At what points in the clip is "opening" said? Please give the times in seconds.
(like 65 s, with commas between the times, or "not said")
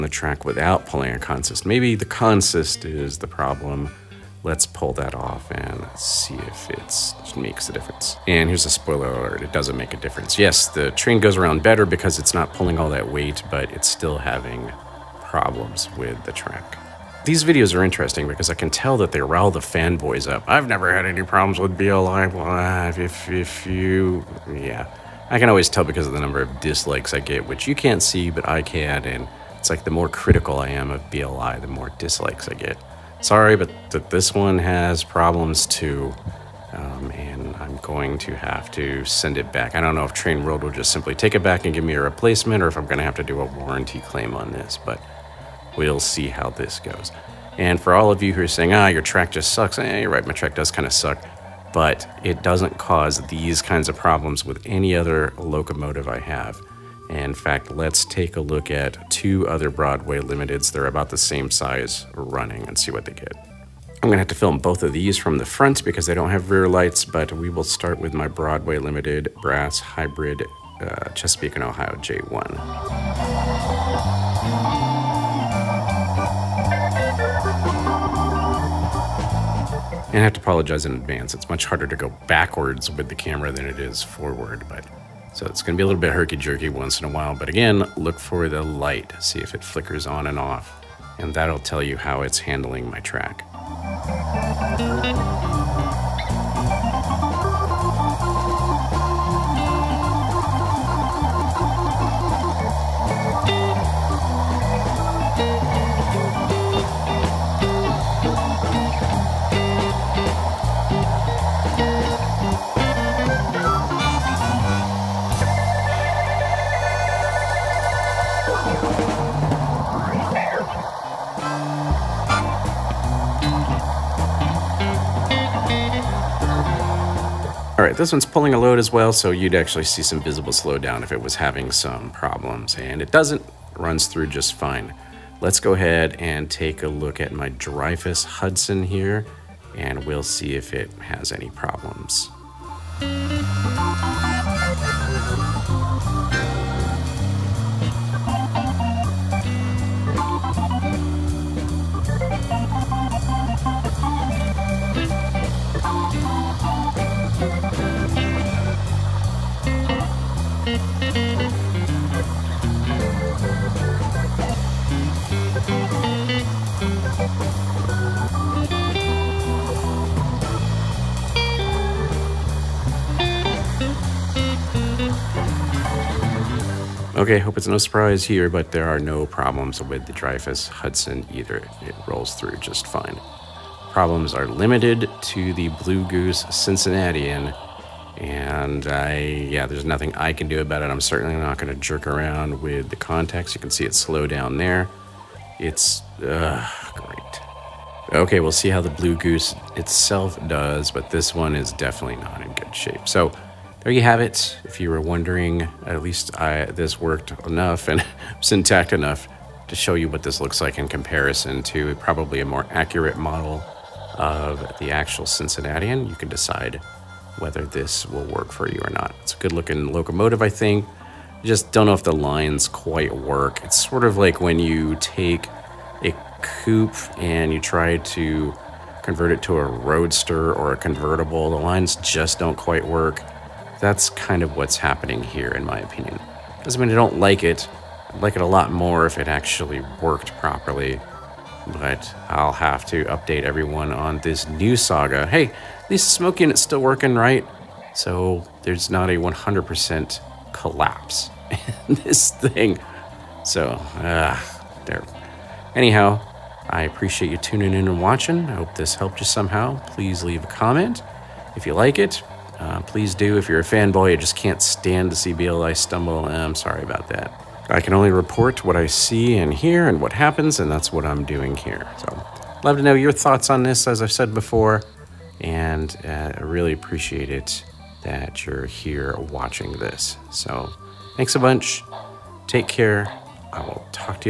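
not said.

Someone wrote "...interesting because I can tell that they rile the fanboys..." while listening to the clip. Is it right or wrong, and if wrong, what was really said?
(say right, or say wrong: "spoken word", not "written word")
right.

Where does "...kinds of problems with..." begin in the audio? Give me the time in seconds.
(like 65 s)
53 s.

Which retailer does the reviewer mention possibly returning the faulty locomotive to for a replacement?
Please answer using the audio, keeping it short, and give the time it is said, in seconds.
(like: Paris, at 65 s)
Train World, at 40 s.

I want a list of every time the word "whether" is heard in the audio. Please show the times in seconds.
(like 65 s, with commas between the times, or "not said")
217 s.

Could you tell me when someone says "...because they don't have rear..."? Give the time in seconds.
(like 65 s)
65 s.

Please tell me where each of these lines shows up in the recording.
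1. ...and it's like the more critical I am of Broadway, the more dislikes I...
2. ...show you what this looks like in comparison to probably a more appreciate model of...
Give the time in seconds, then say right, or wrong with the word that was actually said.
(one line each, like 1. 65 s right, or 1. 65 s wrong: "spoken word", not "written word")
1. 29 s wrong: "BLI", not "Broadway"
2. 209 s wrong: "accurate", not "appreciate".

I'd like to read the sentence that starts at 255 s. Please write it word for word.
Anyhow, I appreciate you tuning in and watching.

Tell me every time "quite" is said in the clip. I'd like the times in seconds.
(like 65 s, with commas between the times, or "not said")
222 s, 232 s.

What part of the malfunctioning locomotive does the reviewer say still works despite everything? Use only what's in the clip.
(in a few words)
smoke unit.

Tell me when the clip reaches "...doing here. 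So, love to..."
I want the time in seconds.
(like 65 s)
271 s.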